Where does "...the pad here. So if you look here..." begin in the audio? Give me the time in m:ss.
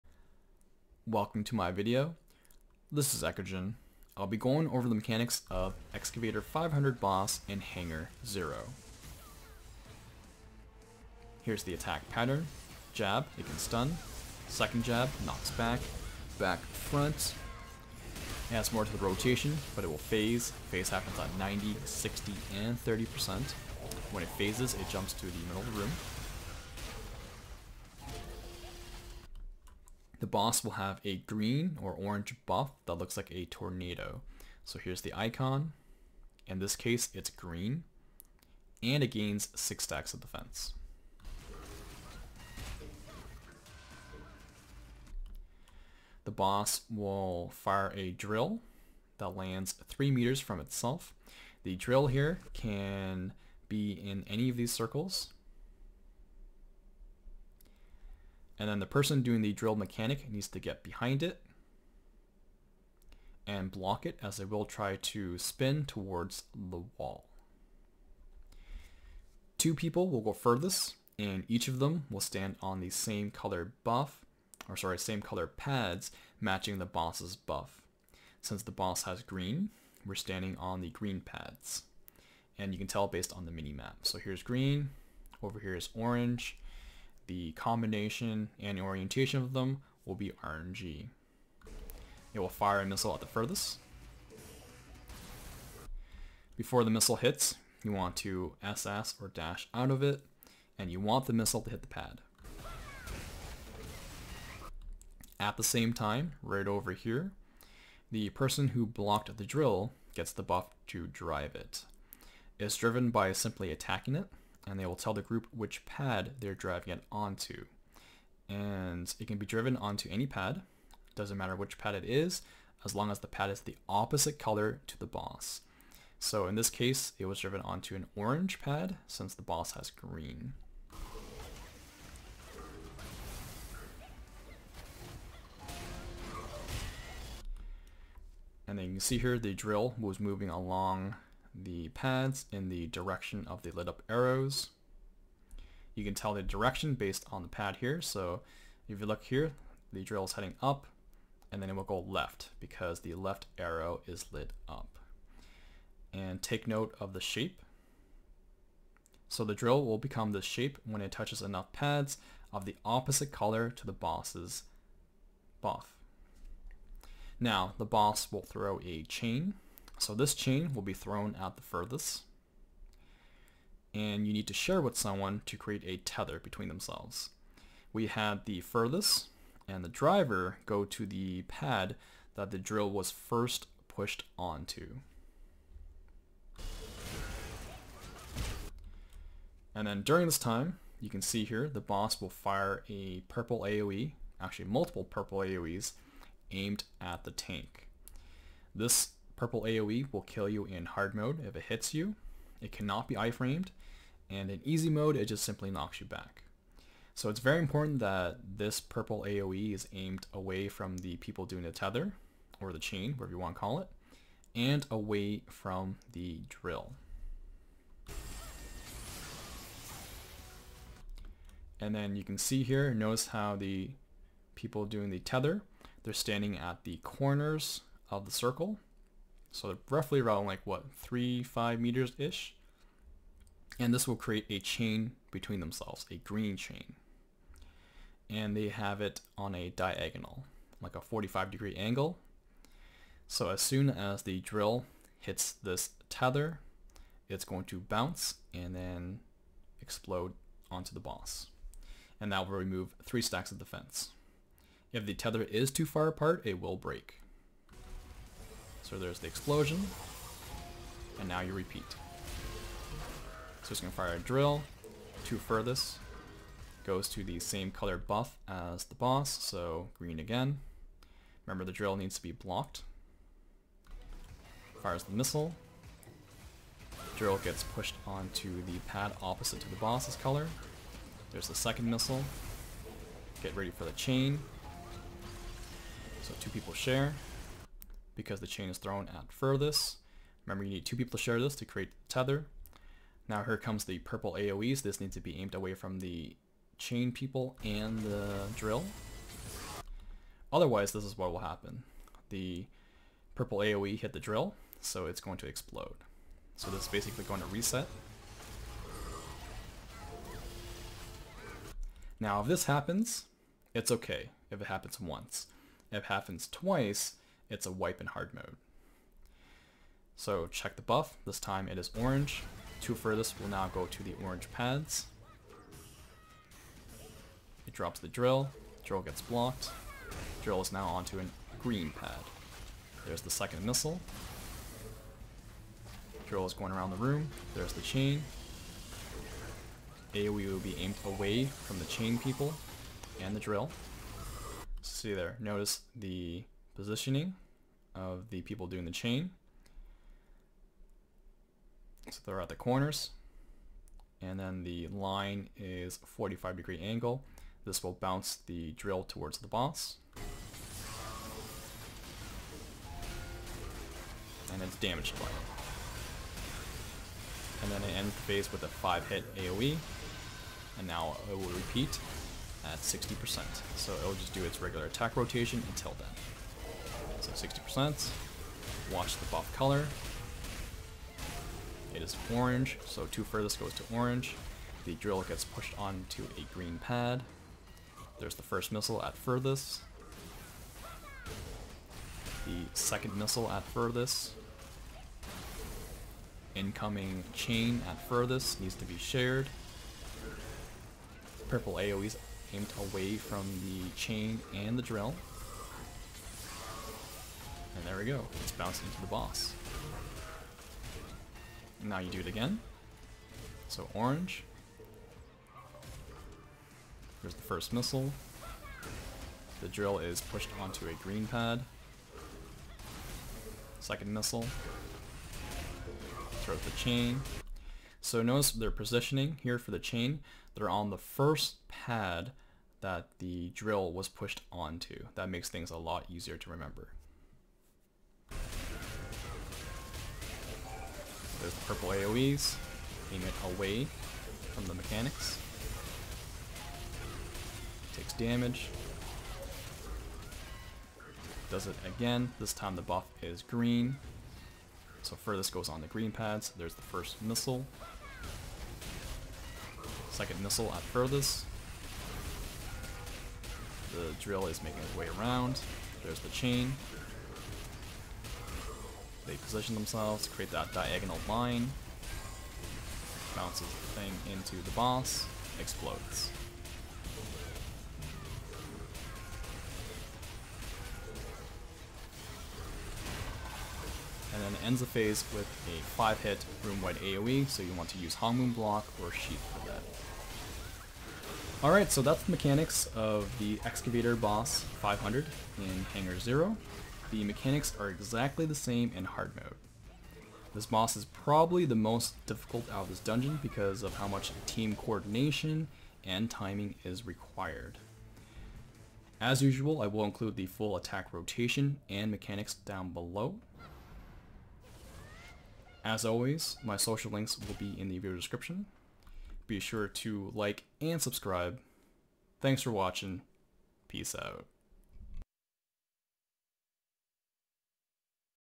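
2:27.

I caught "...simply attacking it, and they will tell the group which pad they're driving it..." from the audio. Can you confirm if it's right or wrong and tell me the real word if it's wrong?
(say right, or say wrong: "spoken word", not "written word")
right.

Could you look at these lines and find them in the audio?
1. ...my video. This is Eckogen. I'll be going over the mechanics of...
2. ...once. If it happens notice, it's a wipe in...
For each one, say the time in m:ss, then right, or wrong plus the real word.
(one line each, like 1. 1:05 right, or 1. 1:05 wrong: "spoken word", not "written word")
1. 0:01 right
2. 5:15 wrong: "twice", not "notice".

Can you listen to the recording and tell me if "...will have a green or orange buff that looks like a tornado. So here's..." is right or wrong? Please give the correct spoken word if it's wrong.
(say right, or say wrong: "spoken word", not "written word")
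right.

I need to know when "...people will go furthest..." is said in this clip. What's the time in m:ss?
1:09.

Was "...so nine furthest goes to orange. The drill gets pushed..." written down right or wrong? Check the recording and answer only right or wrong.
wrong.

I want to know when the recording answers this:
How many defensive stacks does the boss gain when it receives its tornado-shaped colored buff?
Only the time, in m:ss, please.
0:39.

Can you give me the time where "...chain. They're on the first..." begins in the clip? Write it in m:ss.
7:09.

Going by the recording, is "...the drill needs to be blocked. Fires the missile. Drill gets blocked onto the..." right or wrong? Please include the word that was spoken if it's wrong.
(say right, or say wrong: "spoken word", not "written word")
wrong: "pushed", not "blocked".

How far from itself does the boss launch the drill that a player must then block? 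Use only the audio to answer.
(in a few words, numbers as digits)
3 meters.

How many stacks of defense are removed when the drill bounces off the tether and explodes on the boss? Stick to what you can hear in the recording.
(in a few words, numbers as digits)
3.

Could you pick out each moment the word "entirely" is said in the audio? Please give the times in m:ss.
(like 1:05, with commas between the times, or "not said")
not said.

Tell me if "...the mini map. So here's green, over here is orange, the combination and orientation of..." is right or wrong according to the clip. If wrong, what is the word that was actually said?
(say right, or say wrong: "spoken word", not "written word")
right.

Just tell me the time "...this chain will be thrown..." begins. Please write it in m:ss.
2:50.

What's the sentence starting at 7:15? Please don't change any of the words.
That makes things a lot easier to remember.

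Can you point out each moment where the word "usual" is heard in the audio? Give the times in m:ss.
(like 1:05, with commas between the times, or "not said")
8:29.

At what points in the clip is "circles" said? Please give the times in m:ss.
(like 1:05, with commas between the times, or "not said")
0:54, 3:48.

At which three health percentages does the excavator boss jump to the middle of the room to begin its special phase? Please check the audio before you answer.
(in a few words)
90, 60, and 30%.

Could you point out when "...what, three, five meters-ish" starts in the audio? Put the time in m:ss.
3:50.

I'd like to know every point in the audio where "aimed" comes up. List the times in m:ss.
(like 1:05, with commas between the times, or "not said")
3:16, 3:29, 4:55, 5:40, 6:42.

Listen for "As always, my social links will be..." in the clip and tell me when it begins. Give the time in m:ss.
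8:35.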